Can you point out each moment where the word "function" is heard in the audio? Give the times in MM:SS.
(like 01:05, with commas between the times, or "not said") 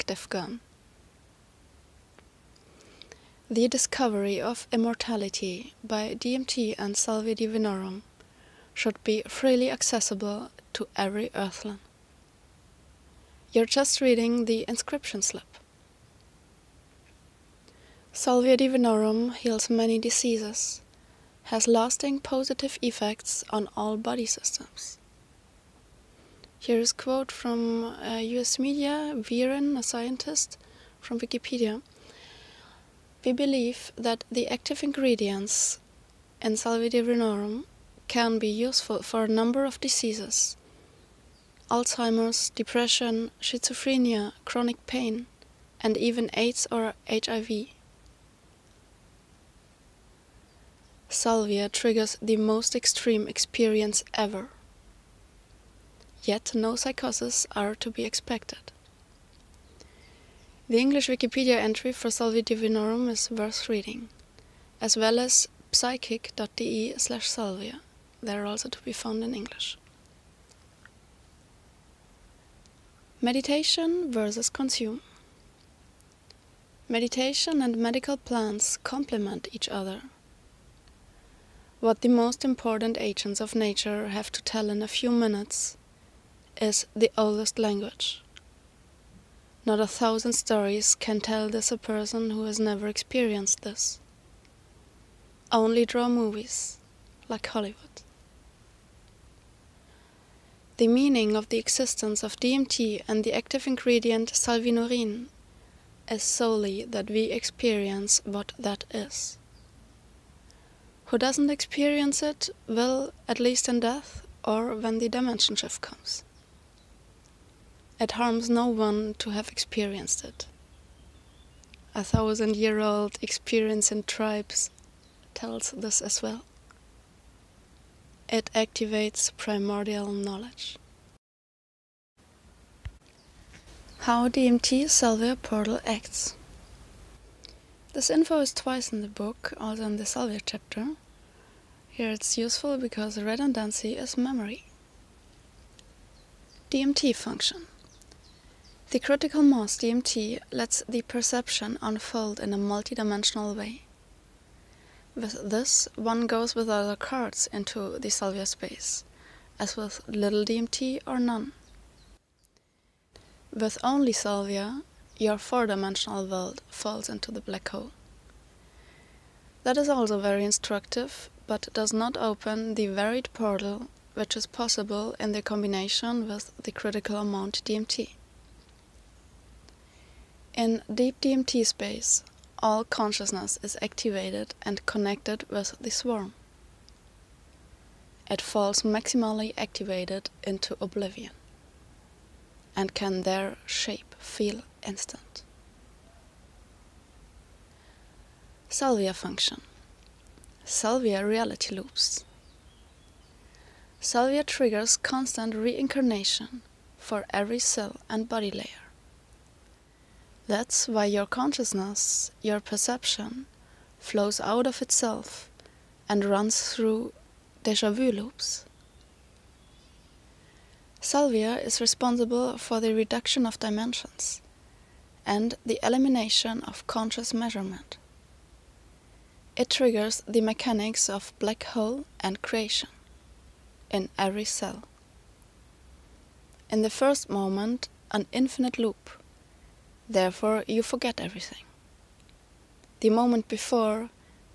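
02:27, 03:19.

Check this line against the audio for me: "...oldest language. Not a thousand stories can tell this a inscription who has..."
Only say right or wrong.
wrong.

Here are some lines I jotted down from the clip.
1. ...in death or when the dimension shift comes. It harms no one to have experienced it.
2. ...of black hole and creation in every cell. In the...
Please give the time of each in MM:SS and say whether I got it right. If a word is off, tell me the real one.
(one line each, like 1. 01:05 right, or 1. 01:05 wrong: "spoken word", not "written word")
1. 01:53 right
2. 03:51 right.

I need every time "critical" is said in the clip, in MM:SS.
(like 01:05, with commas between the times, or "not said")
02:28, 02:56.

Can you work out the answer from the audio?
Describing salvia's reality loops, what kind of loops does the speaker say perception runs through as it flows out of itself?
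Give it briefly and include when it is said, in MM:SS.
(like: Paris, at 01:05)
deja vu loops, at 03:37.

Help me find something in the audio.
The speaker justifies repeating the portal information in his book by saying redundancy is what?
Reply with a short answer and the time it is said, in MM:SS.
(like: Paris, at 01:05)
memory, at 02:24.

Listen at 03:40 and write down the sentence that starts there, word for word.
Salvia is responsible for the reduction of dimensions and the elimination of conscious measurement.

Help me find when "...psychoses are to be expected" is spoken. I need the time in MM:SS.
00:56.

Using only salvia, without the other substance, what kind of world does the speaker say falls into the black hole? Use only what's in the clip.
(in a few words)
four-dimensional.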